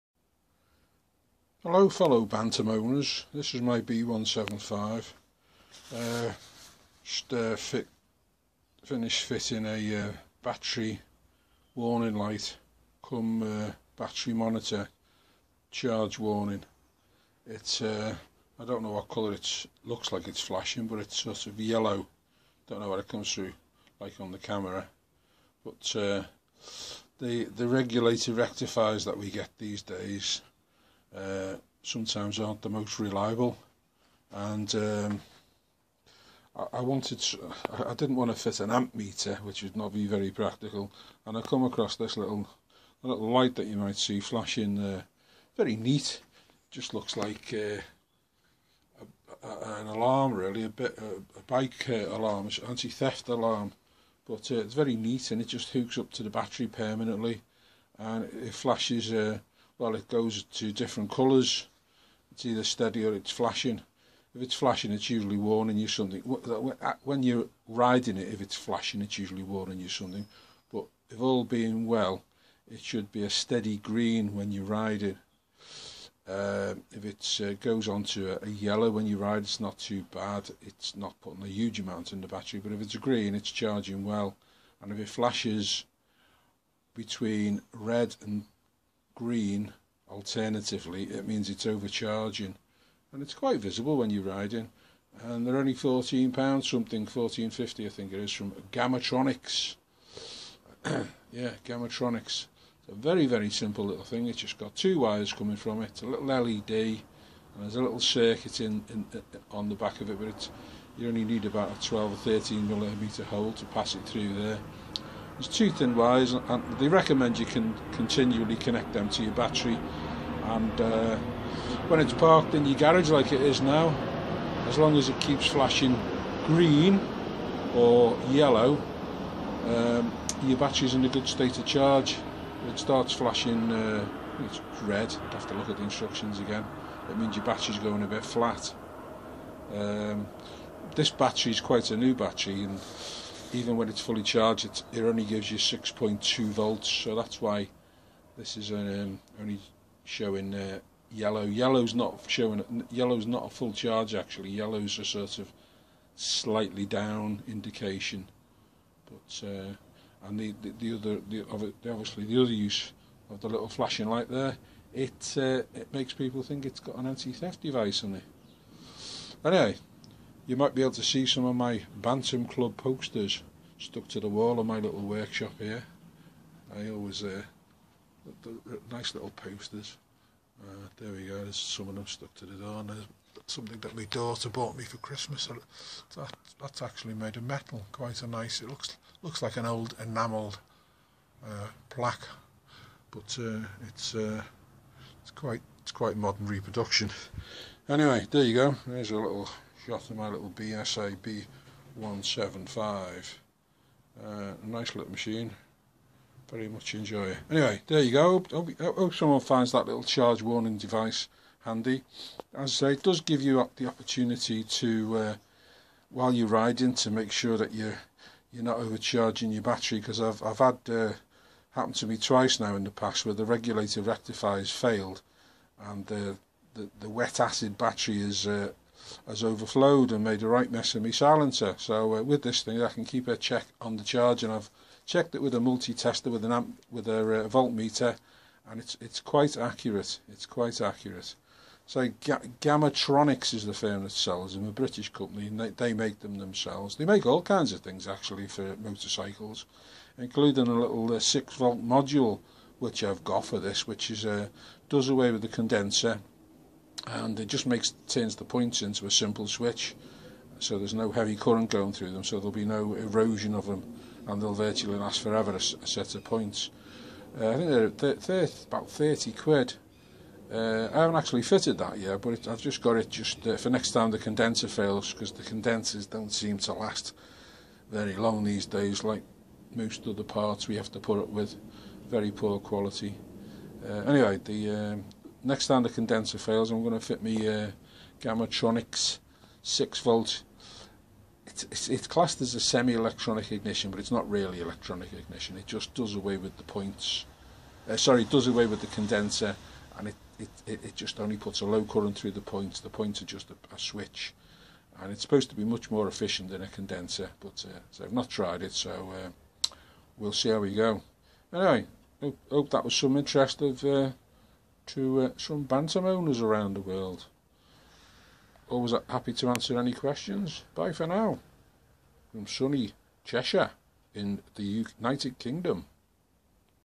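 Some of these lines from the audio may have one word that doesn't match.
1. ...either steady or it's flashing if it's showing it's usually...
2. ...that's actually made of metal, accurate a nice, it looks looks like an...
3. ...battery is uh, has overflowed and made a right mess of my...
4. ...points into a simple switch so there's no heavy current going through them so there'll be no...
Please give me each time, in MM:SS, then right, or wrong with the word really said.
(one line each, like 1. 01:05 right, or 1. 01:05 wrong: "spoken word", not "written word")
1. 01:02 wrong: "flashing", not "showing"
2. 03:06 wrong: "quite", not "accurate"
3. 03:47 right
4. 04:18 right.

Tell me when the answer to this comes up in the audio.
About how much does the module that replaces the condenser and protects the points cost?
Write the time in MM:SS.
04:28.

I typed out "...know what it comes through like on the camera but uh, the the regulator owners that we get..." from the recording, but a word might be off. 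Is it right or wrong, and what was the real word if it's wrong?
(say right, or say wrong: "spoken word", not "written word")
wrong: "rectifiers", not "owners".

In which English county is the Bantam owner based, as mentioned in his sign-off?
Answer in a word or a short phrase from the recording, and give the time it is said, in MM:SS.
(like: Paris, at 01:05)
Cheshire, at 05:23.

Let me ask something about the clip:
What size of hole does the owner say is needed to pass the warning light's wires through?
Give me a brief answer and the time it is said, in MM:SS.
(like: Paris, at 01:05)
12 or 13 millimetres, at 01:51.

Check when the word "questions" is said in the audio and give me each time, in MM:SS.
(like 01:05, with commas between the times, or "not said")
05:19.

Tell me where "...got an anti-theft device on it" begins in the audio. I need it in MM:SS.
02:46.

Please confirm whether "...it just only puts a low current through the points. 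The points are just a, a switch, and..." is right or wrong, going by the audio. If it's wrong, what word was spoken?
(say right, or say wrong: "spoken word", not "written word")
right.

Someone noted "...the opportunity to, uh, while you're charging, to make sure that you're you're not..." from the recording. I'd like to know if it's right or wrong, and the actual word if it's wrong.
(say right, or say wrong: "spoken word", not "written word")
wrong: "riding", not "charging".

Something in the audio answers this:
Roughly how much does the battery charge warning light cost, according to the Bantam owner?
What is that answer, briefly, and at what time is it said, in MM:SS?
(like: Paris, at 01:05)
£14.50, at 01:37.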